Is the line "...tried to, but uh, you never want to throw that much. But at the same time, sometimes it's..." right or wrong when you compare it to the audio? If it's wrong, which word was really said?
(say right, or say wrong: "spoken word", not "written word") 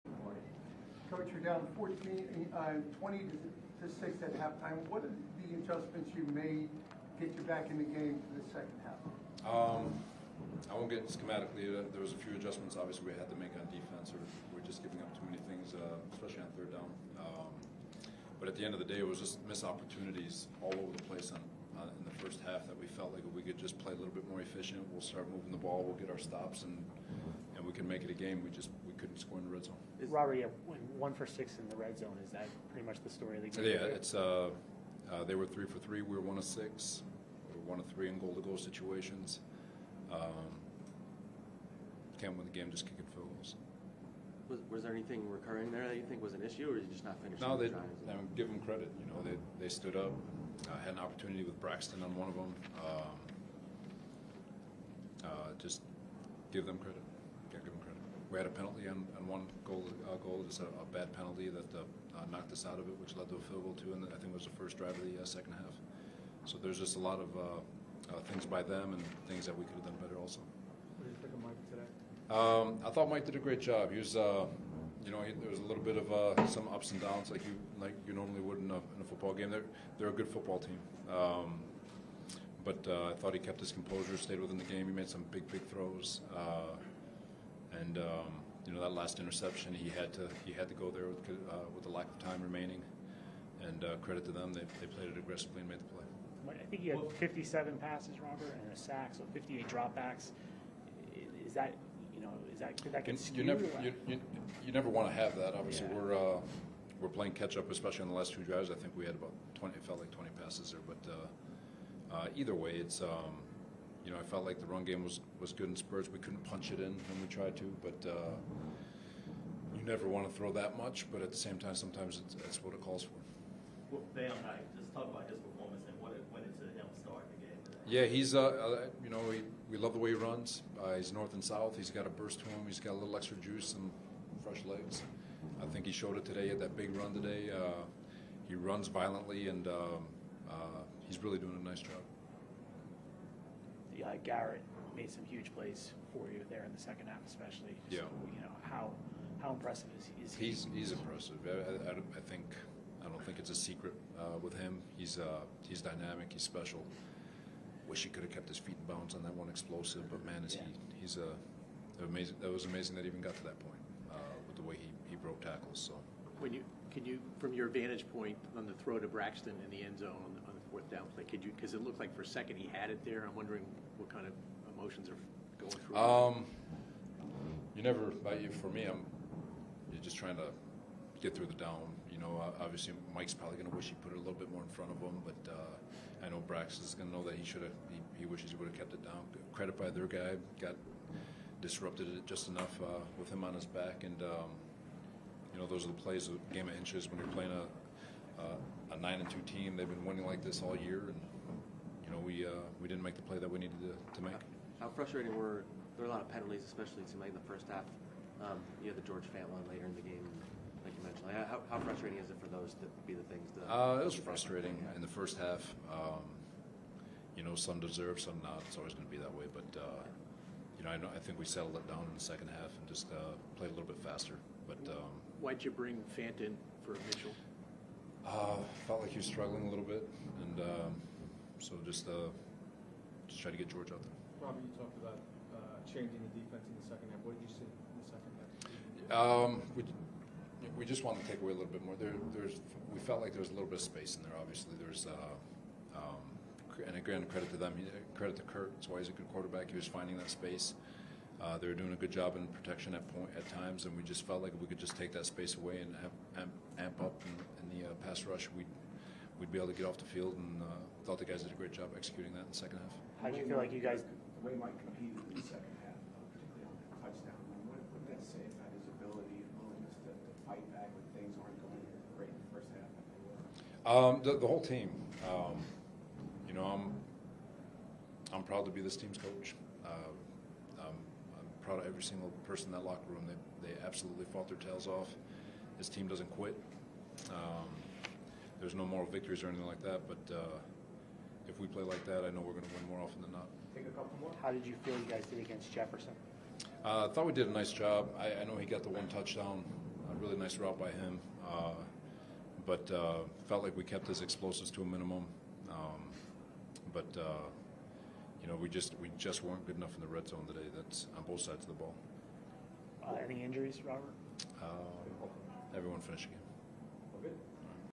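right.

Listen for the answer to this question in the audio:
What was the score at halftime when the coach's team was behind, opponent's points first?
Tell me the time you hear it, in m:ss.
0:02.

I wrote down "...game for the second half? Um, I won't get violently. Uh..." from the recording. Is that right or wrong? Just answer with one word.
wrong.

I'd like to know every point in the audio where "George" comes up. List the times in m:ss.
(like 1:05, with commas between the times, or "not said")
3:29, 3:53.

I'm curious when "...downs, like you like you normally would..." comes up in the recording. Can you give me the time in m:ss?
1:17.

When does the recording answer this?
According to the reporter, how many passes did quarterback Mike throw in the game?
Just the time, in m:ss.
1:37.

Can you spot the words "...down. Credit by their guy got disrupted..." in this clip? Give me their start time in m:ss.
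3:09.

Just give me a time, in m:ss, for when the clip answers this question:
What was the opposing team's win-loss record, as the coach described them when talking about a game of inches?
3:18.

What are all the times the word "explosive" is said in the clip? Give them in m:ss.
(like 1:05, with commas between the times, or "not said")
2:39, 5:04.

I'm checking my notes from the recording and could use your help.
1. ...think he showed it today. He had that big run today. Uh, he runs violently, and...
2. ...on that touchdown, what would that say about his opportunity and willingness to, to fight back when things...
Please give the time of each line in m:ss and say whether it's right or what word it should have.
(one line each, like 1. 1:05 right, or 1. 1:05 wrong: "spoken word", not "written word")
1. 2:15 right
2. 4:26 wrong: "ability", not "opportunity".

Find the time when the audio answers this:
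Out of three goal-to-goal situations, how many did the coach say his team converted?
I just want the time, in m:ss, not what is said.
0:37.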